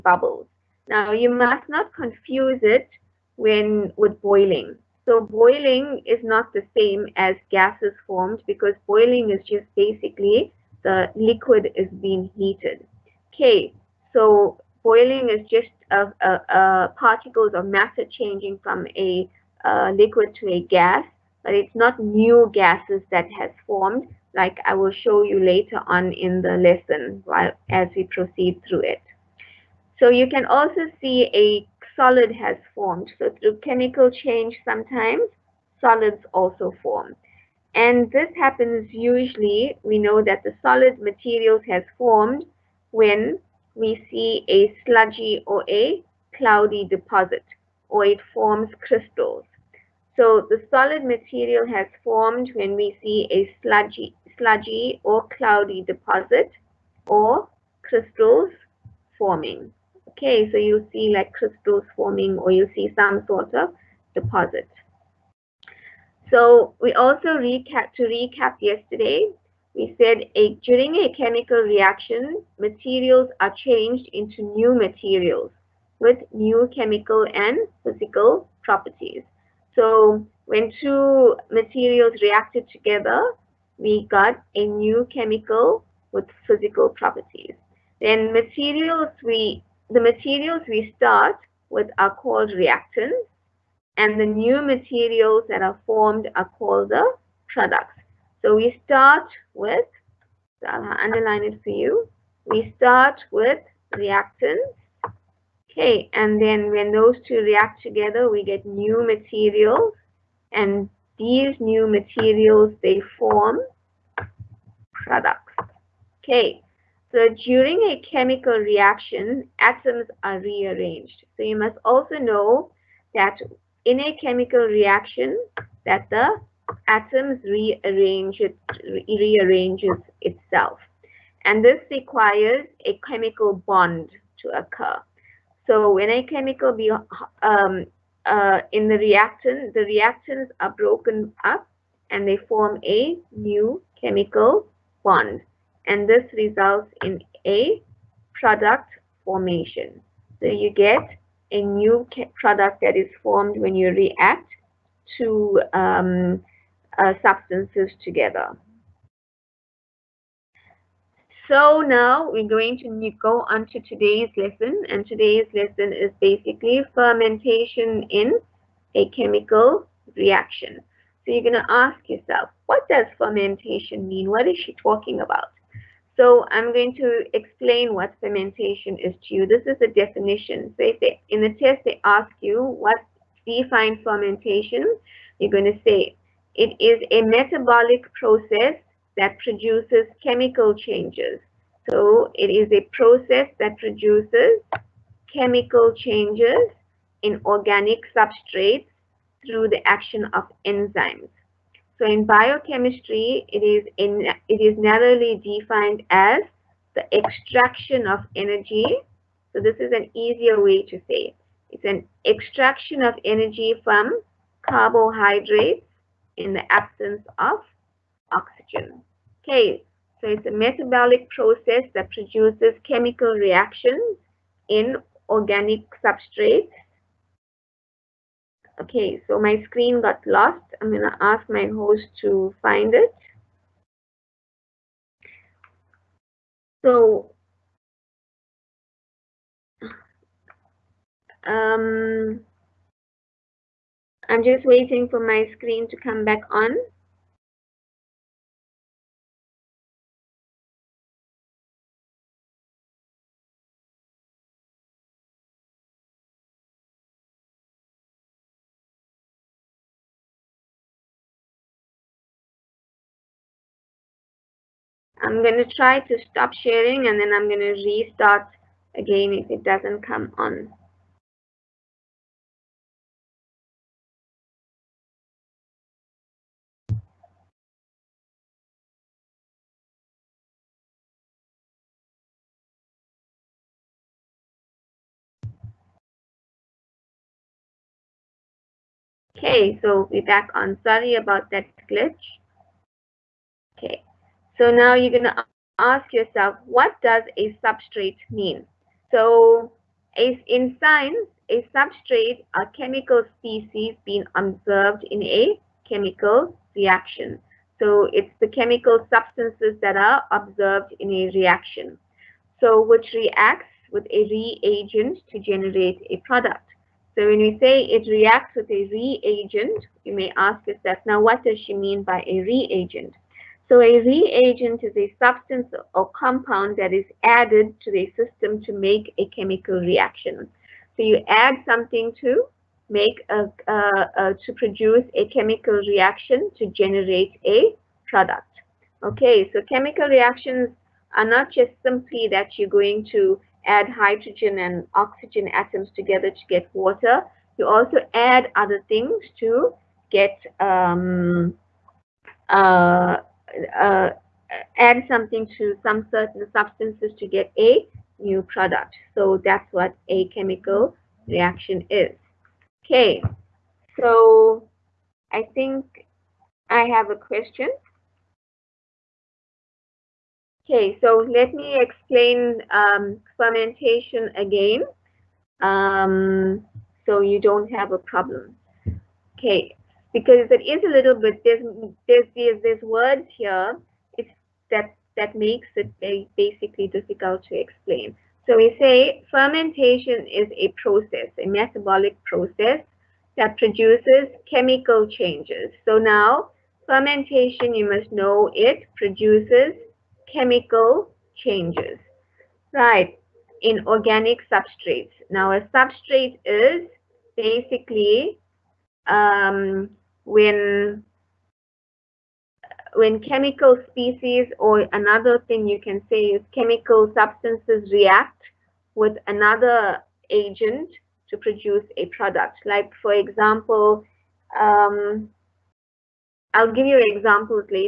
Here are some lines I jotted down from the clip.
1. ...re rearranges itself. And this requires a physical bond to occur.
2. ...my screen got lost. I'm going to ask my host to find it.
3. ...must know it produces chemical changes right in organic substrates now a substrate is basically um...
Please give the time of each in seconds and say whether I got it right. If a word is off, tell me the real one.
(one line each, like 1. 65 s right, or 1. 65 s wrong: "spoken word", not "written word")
1. 128 s wrong: "chemical", not "physical"
2. 229 s right
3. 397 s right.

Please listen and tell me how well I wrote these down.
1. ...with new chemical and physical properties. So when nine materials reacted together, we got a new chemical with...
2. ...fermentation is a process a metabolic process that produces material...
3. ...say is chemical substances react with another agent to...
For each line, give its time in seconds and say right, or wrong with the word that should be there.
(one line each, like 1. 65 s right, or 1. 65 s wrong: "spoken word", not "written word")
1. 75 s wrong: "two", not "nine"
2. 389 s wrong: "chemical", not "material"
3. 416 s right.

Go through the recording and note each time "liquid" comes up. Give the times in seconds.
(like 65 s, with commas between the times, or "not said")
11 s, 19 s.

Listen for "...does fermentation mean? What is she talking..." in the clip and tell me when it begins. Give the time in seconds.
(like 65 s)
172 s.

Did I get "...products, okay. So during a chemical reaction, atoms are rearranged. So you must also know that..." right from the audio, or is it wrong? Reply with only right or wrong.
right.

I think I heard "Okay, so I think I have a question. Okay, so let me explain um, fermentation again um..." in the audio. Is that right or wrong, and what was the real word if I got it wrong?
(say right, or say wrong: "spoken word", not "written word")
right.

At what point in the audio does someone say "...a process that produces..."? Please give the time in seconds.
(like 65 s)
192 s.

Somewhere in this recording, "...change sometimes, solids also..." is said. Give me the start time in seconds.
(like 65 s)
34 s.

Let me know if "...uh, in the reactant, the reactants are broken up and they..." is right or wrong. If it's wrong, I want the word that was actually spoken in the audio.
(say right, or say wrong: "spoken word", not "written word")
right.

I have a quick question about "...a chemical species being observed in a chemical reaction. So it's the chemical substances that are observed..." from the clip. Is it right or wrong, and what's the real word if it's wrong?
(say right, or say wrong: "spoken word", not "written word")
right.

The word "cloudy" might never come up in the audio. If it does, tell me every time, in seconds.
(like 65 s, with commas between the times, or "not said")
46 s, 55 s.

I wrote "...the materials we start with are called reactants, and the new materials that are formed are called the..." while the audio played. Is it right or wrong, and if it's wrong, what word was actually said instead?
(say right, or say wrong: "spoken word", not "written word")
right.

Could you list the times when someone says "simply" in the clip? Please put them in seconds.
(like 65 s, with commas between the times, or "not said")
341 s.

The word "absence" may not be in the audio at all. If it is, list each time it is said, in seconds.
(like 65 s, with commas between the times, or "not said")
216 s.